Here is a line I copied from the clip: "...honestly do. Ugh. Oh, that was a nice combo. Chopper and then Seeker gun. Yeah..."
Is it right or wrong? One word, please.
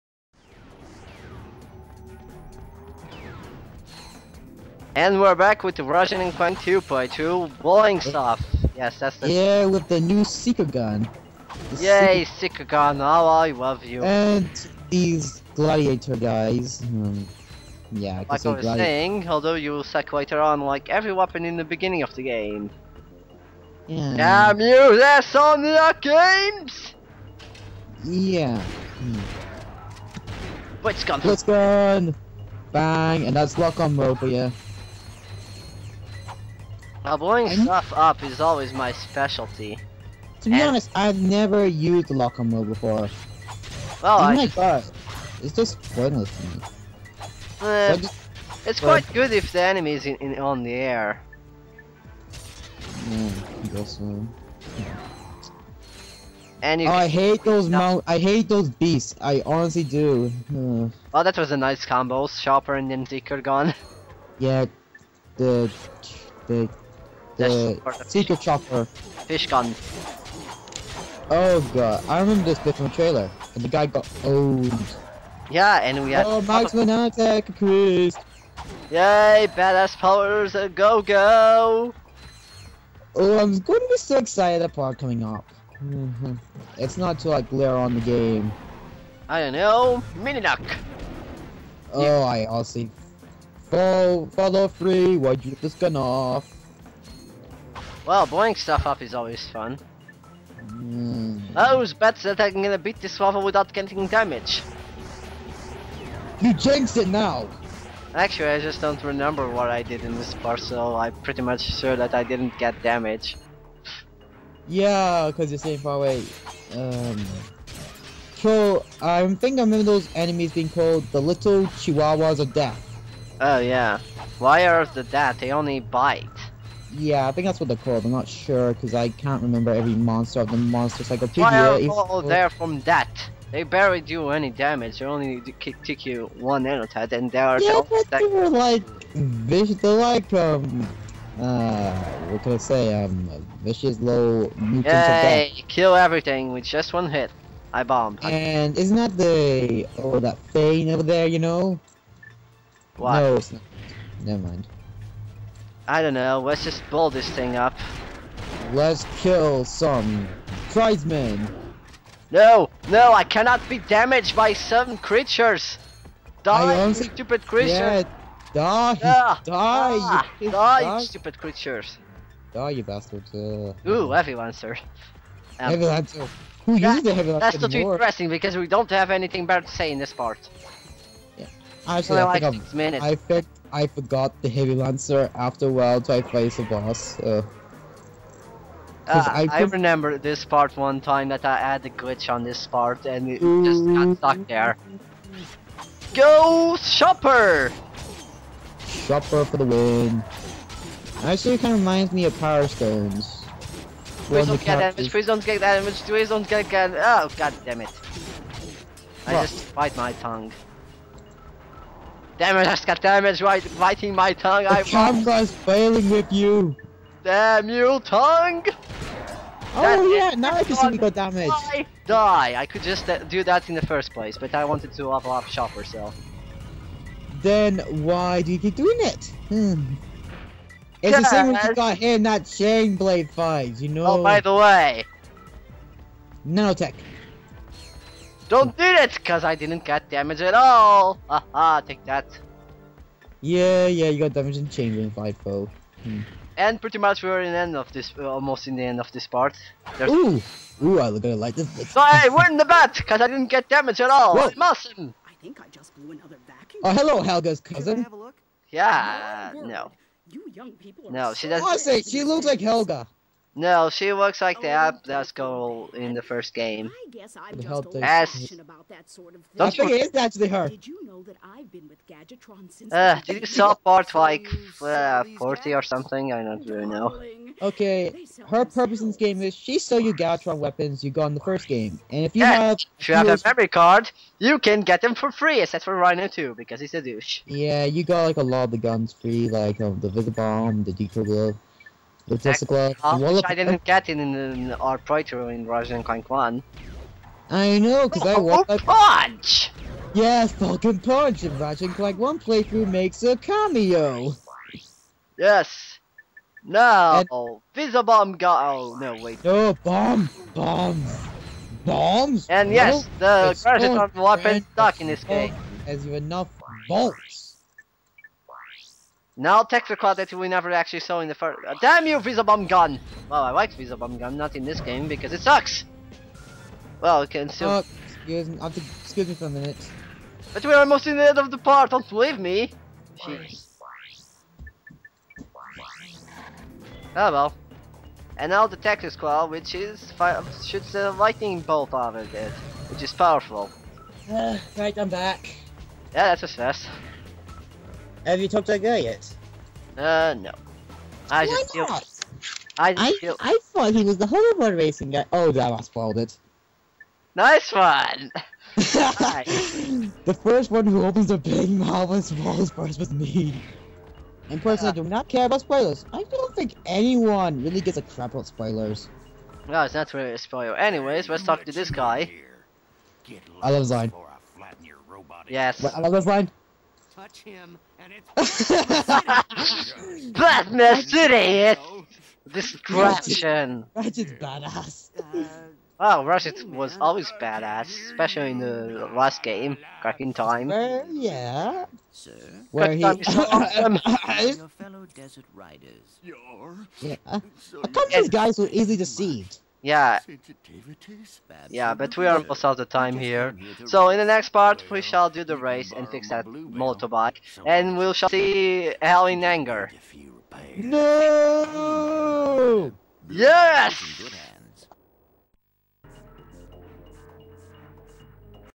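right.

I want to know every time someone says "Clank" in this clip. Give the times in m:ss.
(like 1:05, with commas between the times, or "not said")
0:06, 4:56, 5:01.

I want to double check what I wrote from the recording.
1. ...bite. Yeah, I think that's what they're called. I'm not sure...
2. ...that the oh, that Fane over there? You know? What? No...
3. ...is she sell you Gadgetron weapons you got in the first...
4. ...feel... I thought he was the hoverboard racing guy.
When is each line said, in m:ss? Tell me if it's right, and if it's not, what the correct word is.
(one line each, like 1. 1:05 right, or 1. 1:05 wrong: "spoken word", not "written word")
1. 2:05 right
2. 2:28 right
3. 4:39 right
4. 5:53 right.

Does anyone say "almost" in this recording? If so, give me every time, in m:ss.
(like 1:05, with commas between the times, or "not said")
4:08, 5:30.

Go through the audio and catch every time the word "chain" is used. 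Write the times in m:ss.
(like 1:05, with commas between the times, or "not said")
3:52, 4:04.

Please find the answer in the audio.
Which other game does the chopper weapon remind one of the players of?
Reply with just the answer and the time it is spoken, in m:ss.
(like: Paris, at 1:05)
Power Stones, at 3:22.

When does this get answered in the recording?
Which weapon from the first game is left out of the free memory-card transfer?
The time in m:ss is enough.
4:45.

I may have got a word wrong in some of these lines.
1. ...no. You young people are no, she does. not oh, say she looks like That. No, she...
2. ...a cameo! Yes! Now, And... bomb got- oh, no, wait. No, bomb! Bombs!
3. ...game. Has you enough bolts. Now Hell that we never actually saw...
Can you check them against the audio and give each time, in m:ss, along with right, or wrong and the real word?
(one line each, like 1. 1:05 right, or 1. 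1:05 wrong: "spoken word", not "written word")
1. 4:19 wrong: "Helga", not "That"
2. 5:03 right
3. 5:15 wrong: "Texacrot", not "Hell".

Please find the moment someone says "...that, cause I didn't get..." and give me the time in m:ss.
3:58.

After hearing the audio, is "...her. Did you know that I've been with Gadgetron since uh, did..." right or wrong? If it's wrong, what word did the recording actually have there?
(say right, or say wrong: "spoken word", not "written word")
right.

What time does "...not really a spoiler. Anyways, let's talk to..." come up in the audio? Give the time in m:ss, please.
6:09.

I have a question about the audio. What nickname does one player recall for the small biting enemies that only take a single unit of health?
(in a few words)
Little Chihuahuas of Death.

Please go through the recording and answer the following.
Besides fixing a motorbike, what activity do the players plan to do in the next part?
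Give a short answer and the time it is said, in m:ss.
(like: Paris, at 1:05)
the race, at 6:45.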